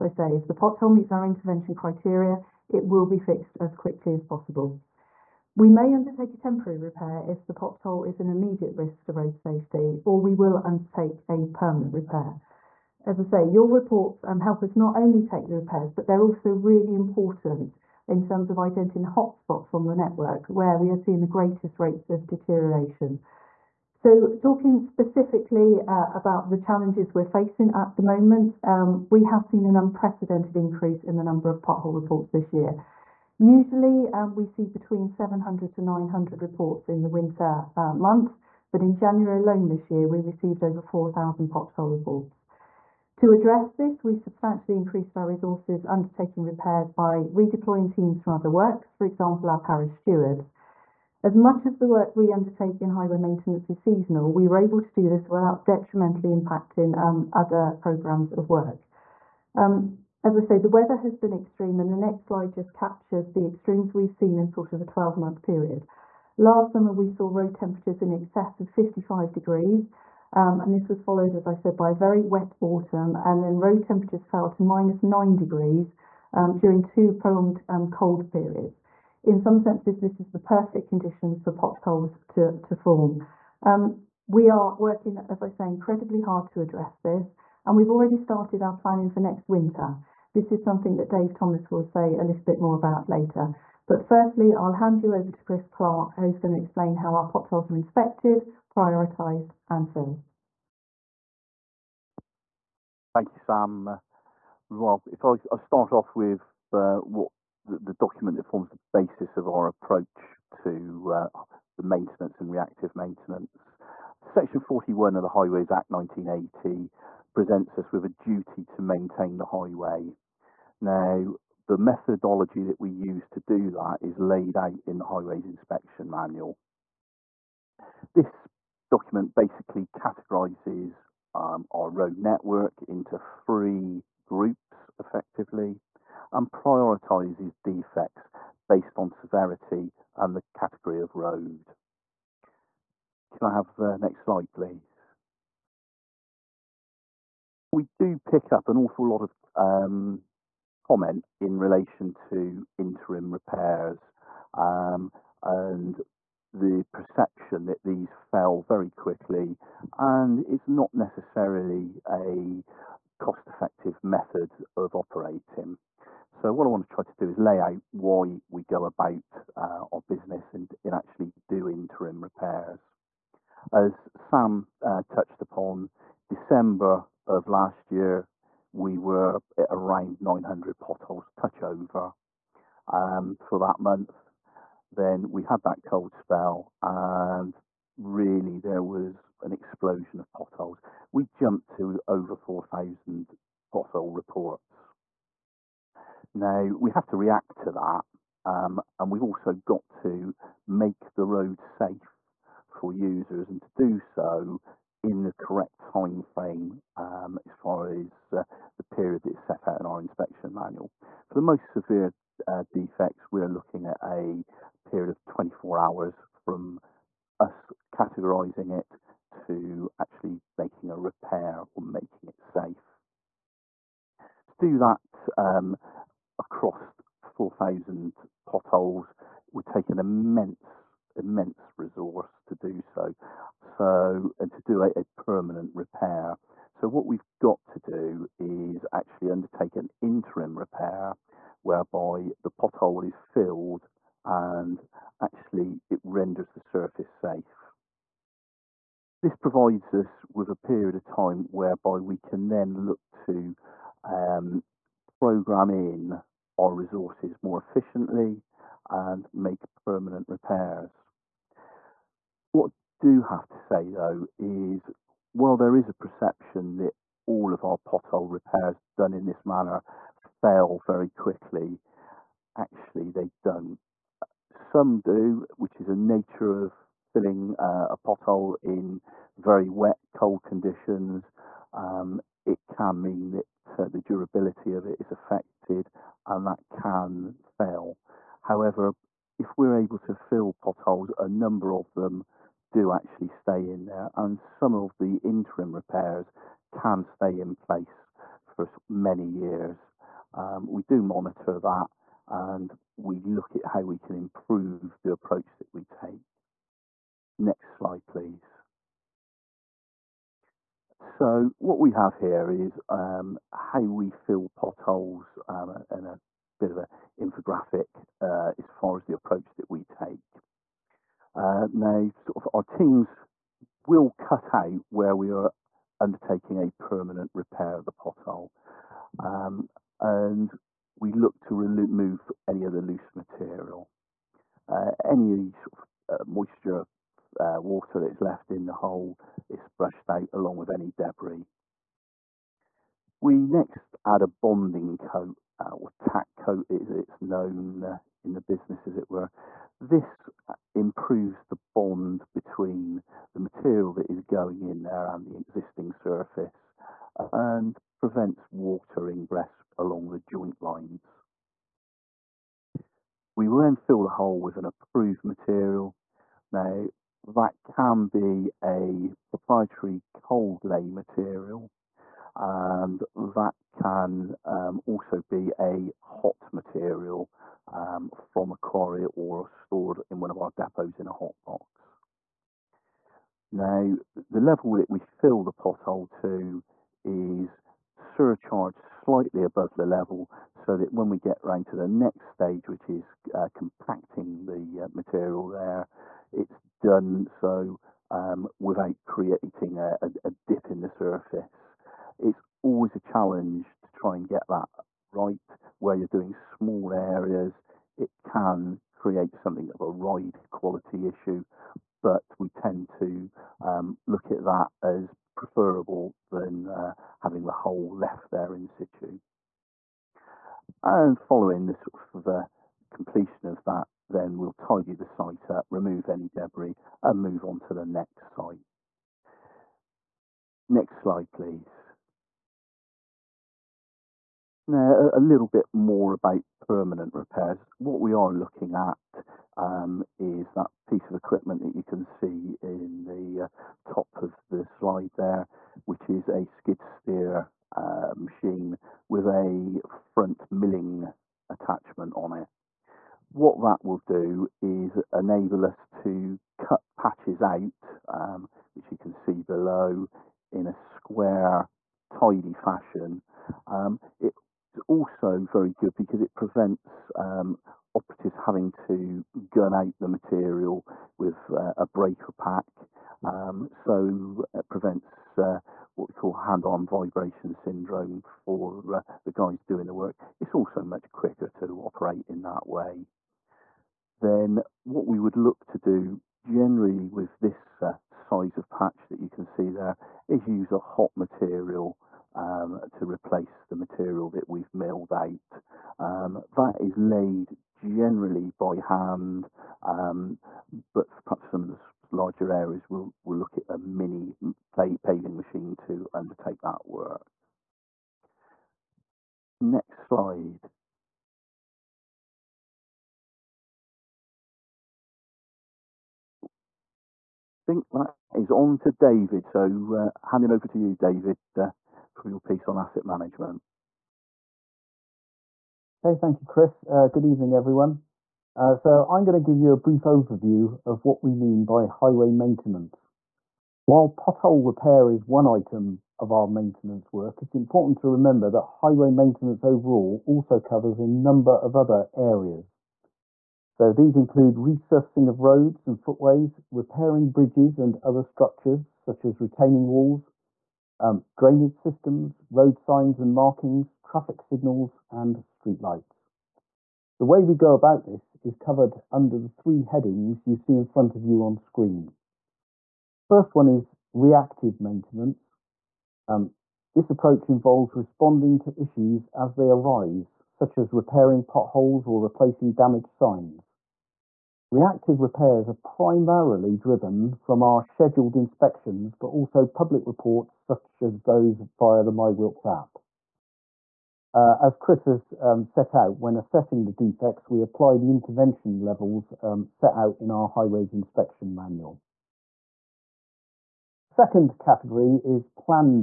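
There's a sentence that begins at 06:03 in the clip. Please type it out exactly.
We will then fill the hole with an approved material.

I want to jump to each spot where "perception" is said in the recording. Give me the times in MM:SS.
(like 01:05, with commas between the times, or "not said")
02:36, 04:25.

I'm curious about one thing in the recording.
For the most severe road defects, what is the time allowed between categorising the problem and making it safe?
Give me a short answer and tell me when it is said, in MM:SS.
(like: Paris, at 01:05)
24 hours, at 03:35.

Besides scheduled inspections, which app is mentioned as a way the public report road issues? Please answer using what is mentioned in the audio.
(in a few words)
MyWilts.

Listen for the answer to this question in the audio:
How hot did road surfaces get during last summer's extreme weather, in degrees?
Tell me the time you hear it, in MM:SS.
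01:08.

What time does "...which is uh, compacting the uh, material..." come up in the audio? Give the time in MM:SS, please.
06:32.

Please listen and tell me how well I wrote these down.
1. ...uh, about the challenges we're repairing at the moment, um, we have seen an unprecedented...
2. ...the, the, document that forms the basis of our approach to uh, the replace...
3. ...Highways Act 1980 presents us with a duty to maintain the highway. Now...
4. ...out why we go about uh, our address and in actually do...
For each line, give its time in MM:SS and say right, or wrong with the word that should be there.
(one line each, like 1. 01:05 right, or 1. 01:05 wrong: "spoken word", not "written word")
1. 00:25 wrong: "facing", not "repairing"
2. 01:47 wrong: "maintenance", not "replace"
3. 01:55 right
4. 02:47 wrong: "business", not "address".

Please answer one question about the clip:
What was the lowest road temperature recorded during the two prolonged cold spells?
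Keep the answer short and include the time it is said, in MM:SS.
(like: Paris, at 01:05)
minus 9 degrees, at 01:14.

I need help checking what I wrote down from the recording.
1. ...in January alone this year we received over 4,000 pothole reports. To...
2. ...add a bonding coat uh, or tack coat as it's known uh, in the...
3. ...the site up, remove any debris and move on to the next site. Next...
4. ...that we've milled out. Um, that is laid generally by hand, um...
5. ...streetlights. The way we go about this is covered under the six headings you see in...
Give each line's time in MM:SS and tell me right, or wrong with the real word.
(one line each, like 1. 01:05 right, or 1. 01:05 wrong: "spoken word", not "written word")
1. 00:38 right
2. 05:44 right
3. 07:04 right
4. 08:14 right
5. 09:15 wrong: "three", not "six".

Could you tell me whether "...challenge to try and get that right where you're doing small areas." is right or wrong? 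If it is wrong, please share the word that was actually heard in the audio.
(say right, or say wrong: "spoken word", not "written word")
right.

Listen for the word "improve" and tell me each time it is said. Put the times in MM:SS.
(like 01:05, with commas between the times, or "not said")
05:04, 05:50.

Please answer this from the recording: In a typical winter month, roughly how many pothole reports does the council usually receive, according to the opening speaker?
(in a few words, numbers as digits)
700 to 900.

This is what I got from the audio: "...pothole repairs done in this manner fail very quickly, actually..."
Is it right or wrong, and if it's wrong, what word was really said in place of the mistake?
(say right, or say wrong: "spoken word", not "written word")
right.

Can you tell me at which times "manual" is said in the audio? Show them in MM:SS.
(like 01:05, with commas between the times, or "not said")
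02:06, 03:30, 09:51.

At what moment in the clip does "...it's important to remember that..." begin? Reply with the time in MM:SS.
08:57.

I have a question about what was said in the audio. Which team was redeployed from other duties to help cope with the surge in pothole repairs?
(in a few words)
parish stewards.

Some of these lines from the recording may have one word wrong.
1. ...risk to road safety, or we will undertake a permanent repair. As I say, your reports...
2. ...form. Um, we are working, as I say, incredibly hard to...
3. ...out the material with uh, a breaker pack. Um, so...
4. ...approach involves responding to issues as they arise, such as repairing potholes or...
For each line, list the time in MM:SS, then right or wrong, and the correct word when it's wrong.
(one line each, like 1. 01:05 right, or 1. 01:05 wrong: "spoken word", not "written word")
1. 00:08 right
2. 01:22 right
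3. 07:49 right
4. 09:27 right.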